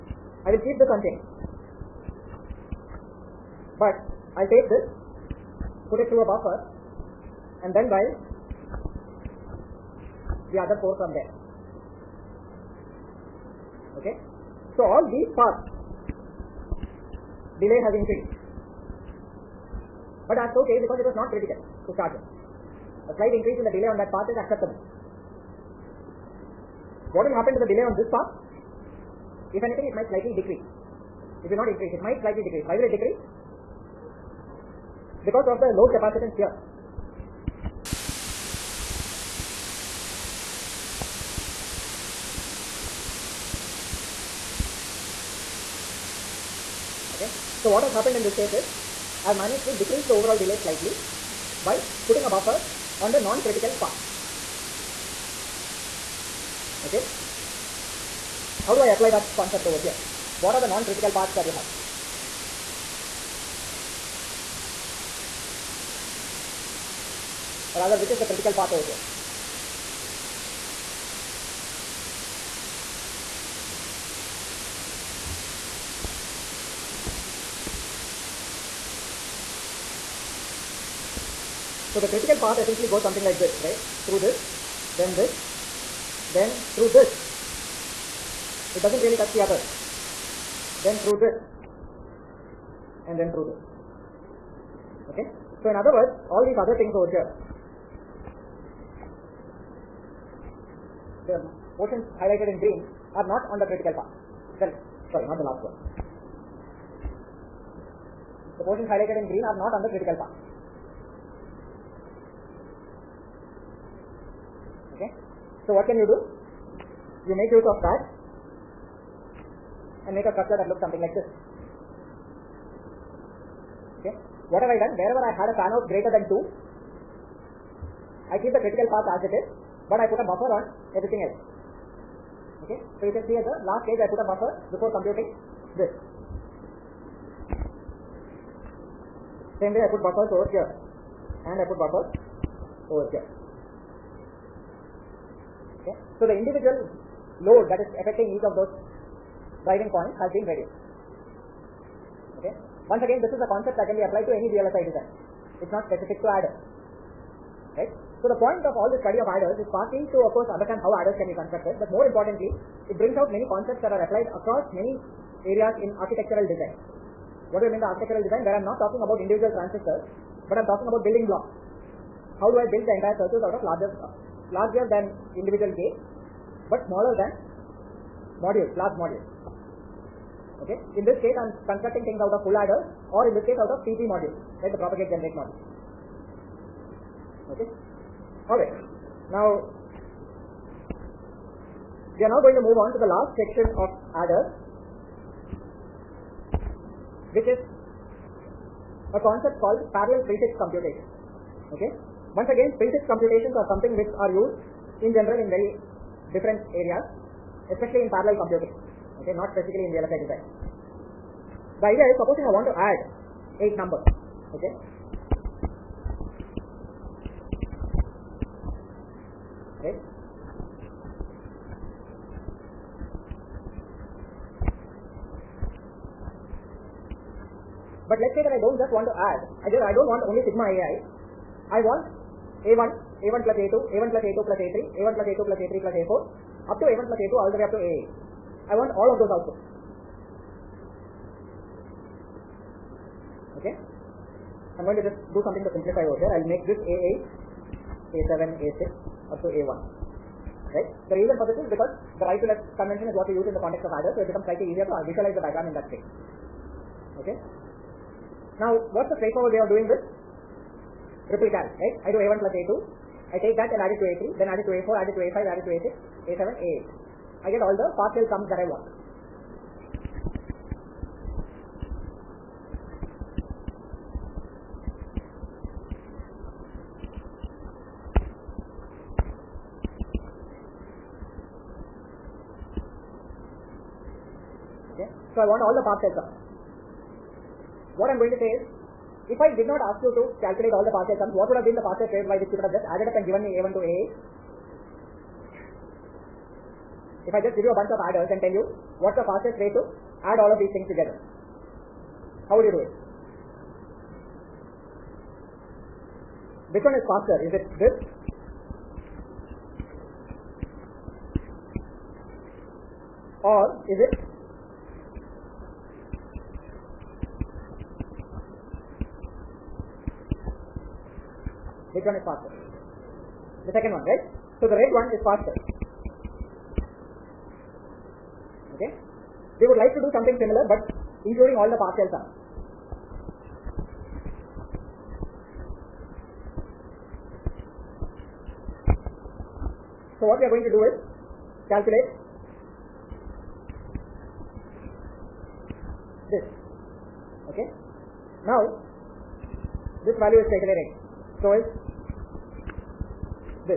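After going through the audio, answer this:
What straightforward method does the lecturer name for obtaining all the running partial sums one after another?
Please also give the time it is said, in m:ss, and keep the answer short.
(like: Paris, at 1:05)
Ripple carry, at 4:21.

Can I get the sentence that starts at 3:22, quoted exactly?
Once again, prefix computations are something which are used in general in very different areas, especially in parallel computing.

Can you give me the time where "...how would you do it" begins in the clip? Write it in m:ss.
5:02.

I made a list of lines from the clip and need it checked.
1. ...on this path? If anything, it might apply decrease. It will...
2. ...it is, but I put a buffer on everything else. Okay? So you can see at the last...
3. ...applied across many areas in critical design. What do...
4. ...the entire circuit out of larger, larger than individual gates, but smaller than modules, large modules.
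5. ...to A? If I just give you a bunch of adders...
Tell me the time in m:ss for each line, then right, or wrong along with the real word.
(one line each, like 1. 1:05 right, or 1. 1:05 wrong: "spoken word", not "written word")
1. 0:27 wrong: "slightly", not "apply"
2. 2:09 right
3. 2:44 wrong: "architectural", not "critical"
4. 2:52 right
5. 4:53 right.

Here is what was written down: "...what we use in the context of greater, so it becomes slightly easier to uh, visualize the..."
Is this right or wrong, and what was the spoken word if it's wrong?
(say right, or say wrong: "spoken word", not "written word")
wrong: "adder", not "greater".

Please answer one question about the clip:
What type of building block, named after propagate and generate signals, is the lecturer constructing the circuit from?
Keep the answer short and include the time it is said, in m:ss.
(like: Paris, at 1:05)
PG modules, at 3:03.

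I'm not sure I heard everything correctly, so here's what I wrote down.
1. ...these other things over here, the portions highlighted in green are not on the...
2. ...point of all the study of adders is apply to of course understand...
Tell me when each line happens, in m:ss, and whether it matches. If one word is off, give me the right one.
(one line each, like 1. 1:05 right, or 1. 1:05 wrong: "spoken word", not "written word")
1. 1:36 right
2. 2:38 wrong: "partly", not "apply".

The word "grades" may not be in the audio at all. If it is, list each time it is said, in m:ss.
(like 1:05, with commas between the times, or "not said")
not said.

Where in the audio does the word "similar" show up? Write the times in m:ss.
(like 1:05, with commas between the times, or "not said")
5:30.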